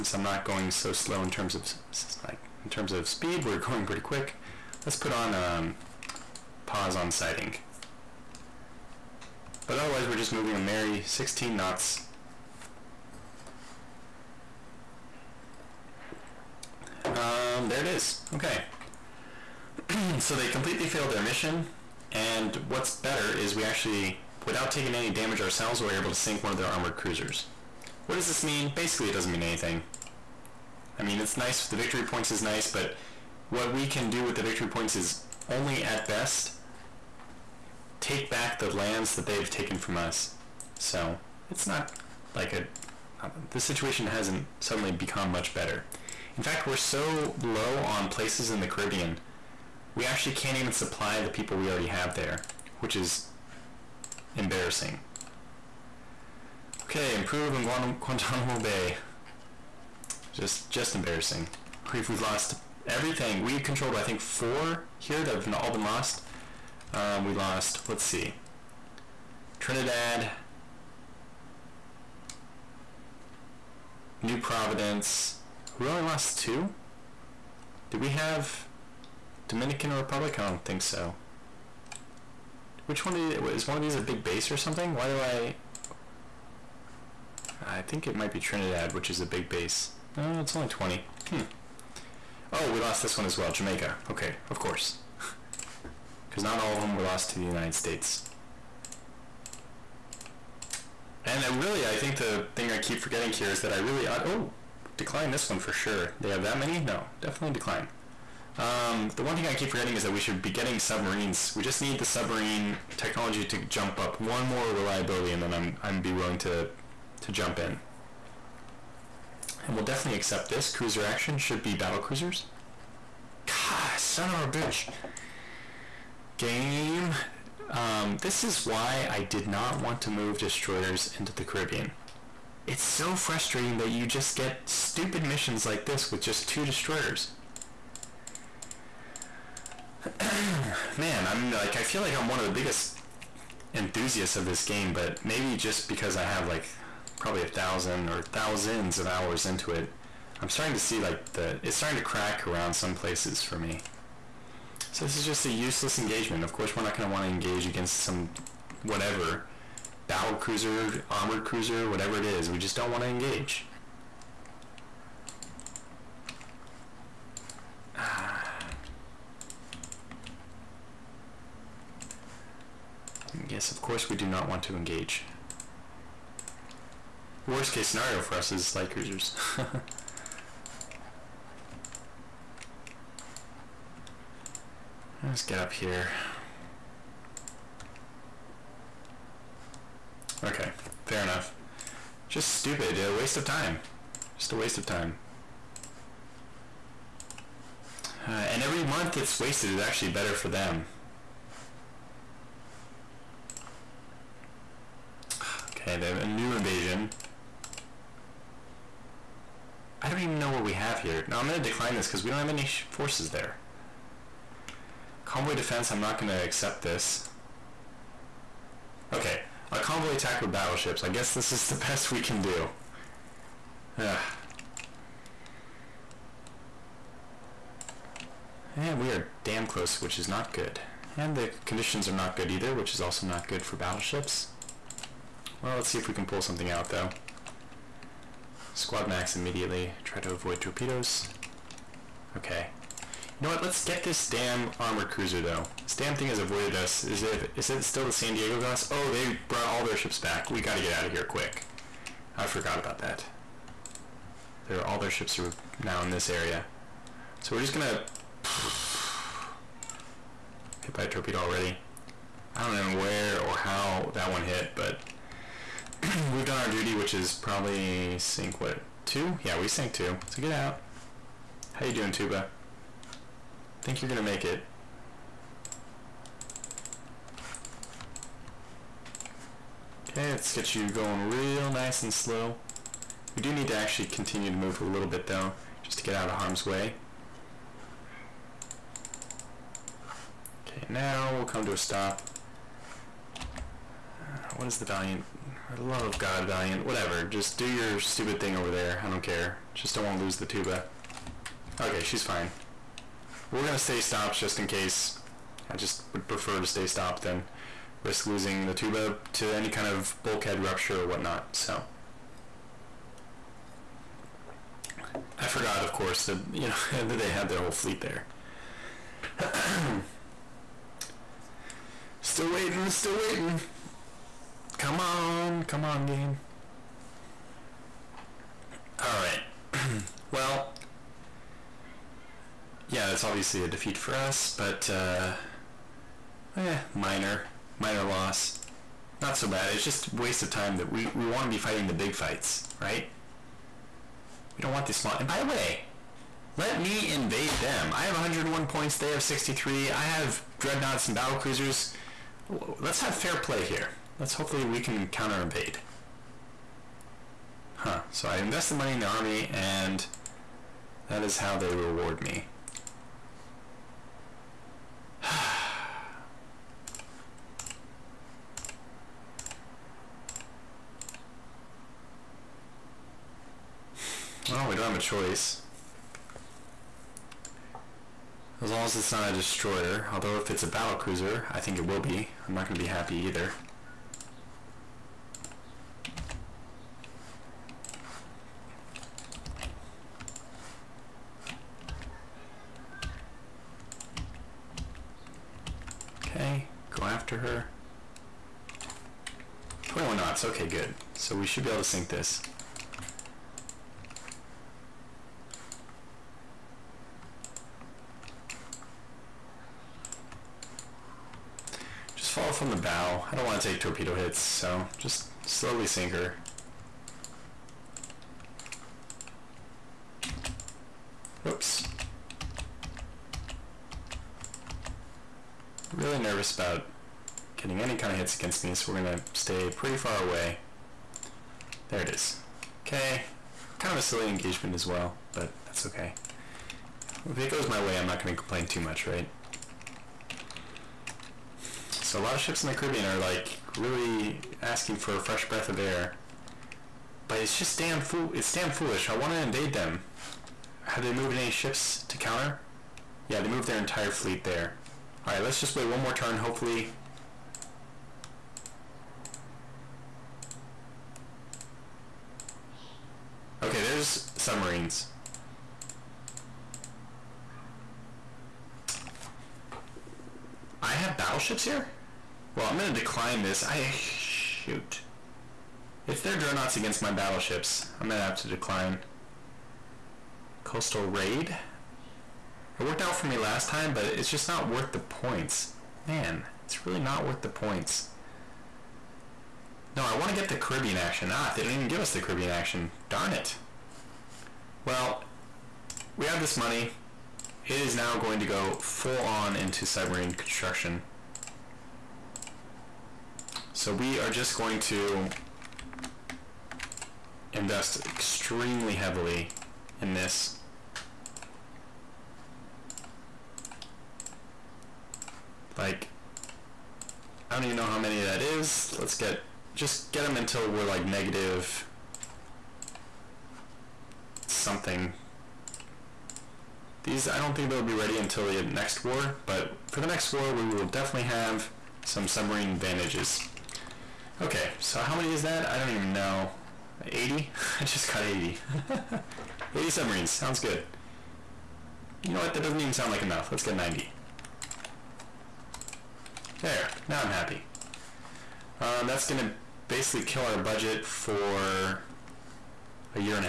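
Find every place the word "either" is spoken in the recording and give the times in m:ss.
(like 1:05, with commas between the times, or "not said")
3:52, 6:23.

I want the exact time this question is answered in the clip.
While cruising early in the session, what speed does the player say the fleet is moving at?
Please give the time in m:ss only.
0:11.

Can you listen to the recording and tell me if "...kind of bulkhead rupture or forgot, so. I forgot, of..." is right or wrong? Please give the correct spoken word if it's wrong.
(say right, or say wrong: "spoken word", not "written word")
wrong: "whatnot", not "forgot".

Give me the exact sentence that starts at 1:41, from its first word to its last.
And I really, I think the thing I keep forgetting here is that I really...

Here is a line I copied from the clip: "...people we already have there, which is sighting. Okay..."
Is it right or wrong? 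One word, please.
wrong.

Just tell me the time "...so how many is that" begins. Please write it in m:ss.
8:54.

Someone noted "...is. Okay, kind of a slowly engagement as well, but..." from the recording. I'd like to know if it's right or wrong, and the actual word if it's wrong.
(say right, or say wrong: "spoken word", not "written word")
wrong: "silly", not "slowly".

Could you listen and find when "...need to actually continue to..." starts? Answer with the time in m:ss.
4:43.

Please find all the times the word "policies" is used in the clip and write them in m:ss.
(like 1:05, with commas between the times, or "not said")
not said.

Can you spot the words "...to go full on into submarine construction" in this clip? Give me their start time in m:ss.
8:18.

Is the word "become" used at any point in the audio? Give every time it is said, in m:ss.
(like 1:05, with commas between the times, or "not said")
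0:44.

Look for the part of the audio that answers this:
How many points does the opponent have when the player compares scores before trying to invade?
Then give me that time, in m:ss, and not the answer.
5:49.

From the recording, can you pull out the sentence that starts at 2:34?
So this is just a useless engagement.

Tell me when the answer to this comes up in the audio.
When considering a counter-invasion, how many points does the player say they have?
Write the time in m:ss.
5:48.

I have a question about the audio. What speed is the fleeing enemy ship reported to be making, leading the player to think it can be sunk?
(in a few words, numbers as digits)
21 knots.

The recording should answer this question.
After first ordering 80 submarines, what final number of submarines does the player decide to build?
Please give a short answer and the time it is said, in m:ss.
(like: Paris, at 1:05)
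90, at 9:03.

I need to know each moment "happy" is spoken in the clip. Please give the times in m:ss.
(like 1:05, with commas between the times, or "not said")
6:22, 9:07.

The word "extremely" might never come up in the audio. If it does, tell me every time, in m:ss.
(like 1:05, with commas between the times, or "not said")
8:28.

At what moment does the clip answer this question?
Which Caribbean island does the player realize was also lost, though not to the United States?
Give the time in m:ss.
1:33.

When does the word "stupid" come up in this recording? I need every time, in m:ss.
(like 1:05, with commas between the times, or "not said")
2:14, 3:12, 4:57.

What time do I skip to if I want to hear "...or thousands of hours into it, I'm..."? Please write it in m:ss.
2:28.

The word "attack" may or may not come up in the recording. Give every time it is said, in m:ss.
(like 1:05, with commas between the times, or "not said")
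3:40.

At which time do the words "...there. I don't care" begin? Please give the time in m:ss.
4:58.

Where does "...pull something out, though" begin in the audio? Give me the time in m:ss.
3:56.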